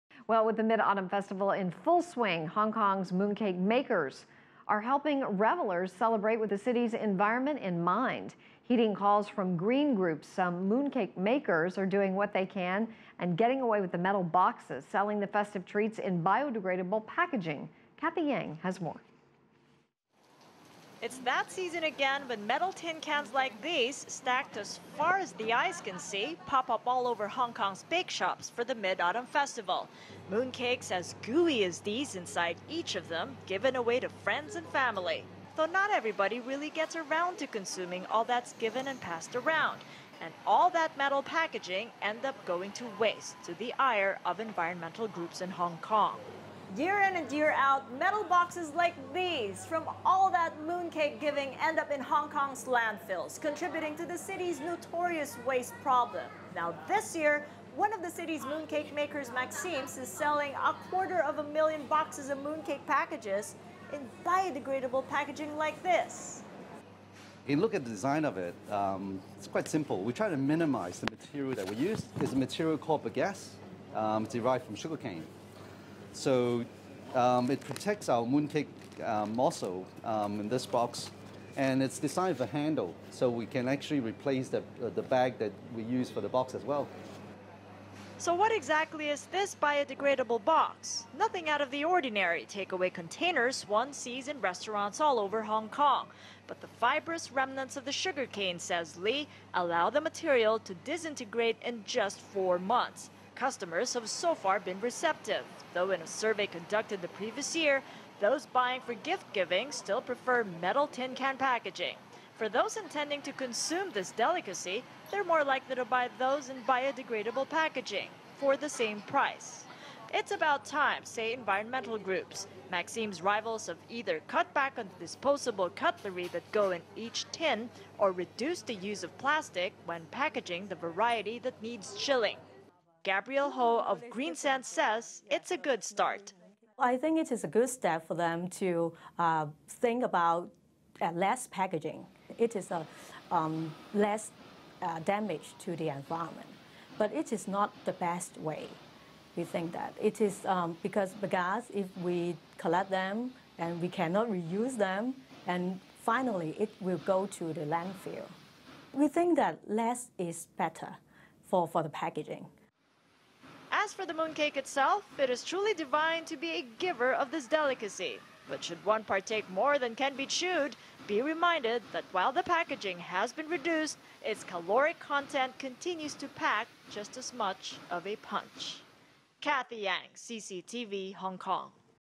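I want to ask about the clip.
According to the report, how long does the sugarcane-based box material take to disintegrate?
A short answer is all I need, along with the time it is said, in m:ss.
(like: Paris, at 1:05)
4 months, at 1:42.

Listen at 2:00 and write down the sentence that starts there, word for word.
It's about time, say environmental groups.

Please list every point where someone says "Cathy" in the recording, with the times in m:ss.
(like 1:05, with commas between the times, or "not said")
0:17, 2:59.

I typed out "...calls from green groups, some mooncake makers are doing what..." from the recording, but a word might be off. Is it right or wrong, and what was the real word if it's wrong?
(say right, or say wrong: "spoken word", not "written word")
right.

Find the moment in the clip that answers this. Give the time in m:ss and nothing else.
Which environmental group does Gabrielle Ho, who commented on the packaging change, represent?
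2:14.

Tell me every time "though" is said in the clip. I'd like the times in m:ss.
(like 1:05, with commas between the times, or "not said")
0:35, 1:45.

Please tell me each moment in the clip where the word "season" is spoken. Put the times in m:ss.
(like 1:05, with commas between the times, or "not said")
0:21.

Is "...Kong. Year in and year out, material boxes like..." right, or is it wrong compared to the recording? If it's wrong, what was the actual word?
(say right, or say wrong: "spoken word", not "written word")
wrong: "metal", not "material".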